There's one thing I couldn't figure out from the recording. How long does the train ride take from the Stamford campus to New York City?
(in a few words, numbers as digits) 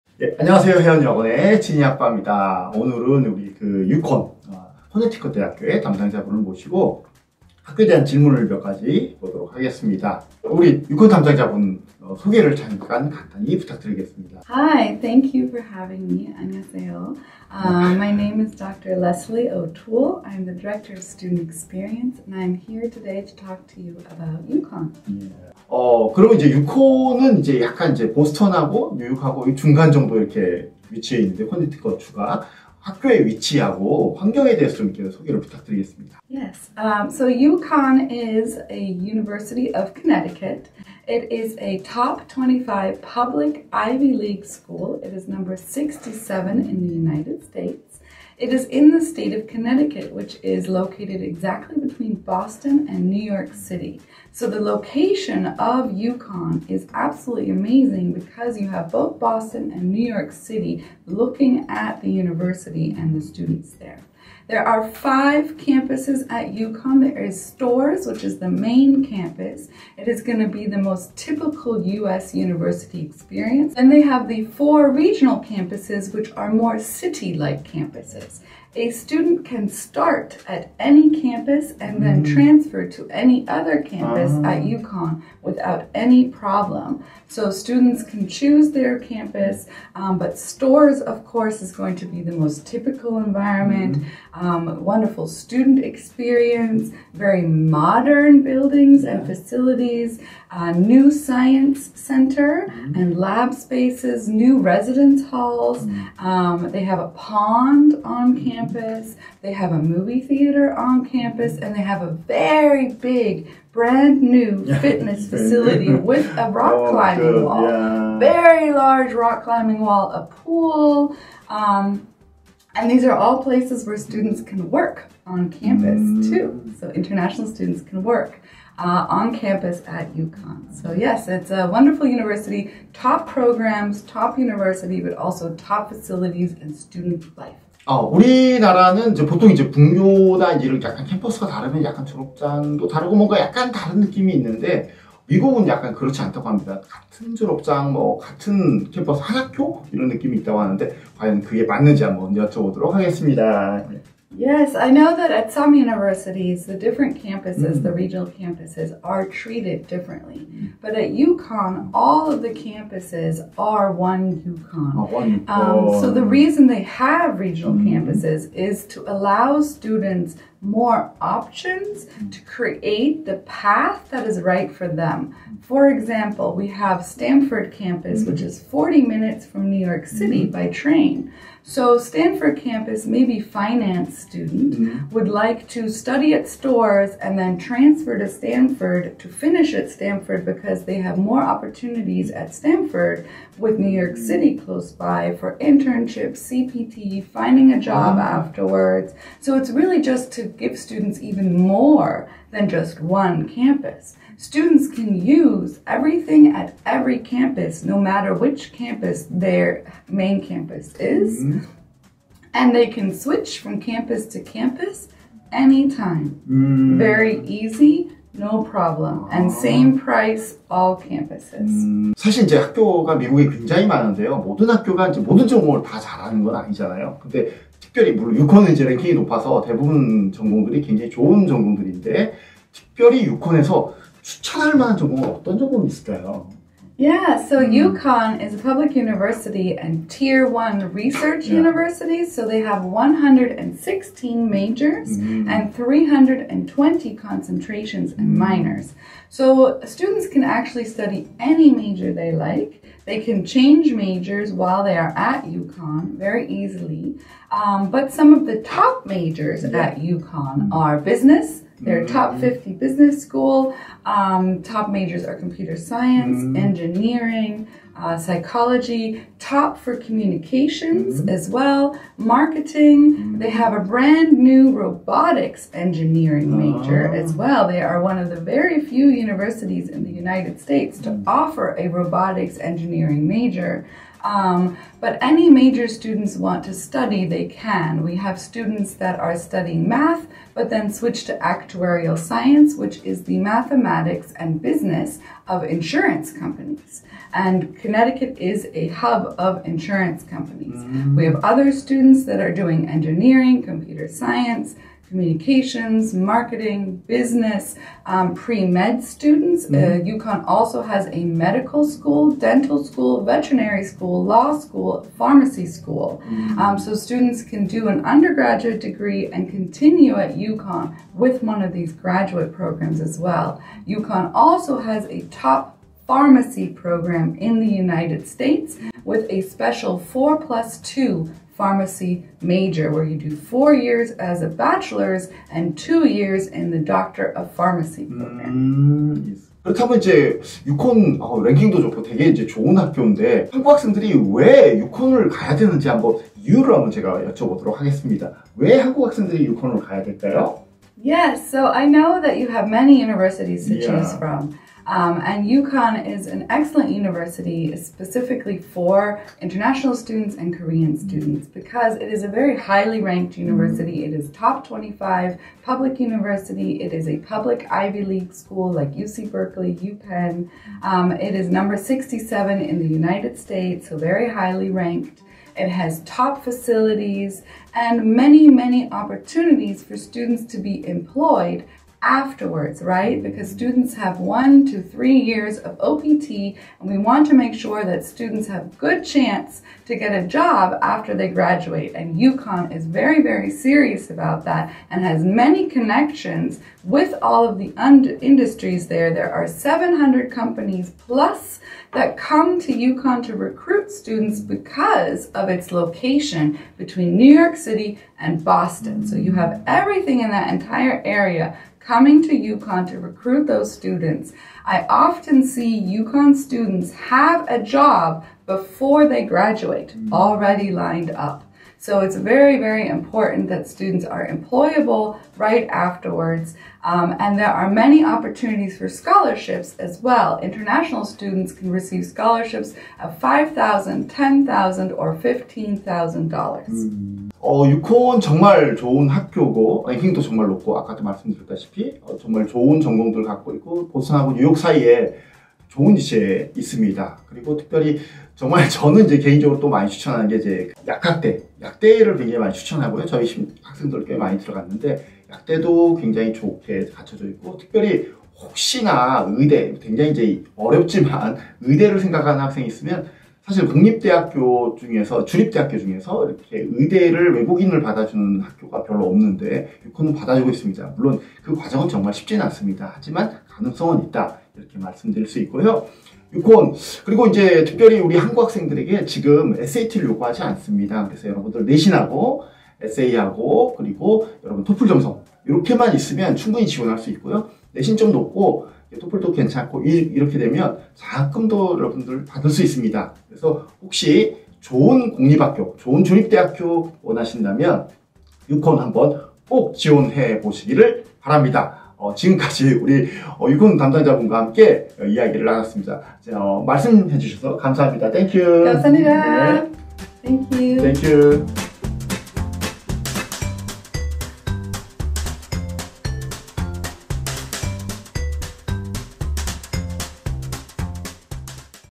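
40 minutes.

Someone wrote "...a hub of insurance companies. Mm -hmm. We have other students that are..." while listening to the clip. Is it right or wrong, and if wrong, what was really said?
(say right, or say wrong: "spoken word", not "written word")
right.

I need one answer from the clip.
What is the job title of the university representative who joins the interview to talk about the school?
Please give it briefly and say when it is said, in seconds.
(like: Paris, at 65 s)
Director of Student Experience, at 20 s.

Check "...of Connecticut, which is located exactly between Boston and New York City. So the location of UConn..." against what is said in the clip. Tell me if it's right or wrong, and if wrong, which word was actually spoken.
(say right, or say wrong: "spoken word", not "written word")
right.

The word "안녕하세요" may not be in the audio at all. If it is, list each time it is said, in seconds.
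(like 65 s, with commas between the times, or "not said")
0 s, 16 s.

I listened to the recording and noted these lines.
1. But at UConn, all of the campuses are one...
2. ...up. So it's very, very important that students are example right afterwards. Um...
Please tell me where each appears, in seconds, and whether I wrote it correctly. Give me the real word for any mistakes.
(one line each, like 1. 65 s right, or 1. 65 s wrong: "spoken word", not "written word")
1. 160 s right
2. 421 s wrong: "employable", not "example".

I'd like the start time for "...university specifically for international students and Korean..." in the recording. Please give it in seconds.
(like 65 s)
356 s.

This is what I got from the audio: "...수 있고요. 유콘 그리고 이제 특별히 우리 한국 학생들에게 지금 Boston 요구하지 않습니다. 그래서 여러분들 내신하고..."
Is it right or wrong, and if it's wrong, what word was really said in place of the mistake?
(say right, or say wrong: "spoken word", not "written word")
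wrong: "SAT를", not "Boston".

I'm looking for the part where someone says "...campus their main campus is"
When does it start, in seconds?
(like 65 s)
208 s.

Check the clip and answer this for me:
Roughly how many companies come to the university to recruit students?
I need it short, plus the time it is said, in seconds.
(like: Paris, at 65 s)
700, at 399 s.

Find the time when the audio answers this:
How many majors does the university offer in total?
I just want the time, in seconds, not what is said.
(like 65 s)
242 s.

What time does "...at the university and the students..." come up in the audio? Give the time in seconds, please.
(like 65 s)
61 s.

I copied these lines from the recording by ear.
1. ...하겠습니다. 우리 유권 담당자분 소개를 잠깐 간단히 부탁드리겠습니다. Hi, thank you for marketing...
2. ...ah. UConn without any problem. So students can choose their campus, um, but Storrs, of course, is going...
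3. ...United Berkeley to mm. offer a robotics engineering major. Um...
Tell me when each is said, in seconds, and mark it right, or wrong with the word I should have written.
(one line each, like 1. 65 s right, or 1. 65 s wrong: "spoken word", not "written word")
1. 9 s wrong: "having", not "marketing"
2. 84 s right
3. 280 s wrong: "States", not "Berkeley".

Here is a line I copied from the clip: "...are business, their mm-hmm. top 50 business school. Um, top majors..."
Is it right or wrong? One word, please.
right.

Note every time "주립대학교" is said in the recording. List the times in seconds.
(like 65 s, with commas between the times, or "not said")
465 s, 496 s.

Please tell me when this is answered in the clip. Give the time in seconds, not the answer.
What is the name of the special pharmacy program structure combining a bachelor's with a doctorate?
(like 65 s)
329 s.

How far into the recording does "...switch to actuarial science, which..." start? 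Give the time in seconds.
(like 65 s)
290 s.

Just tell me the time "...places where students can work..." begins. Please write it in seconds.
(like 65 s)
123 s.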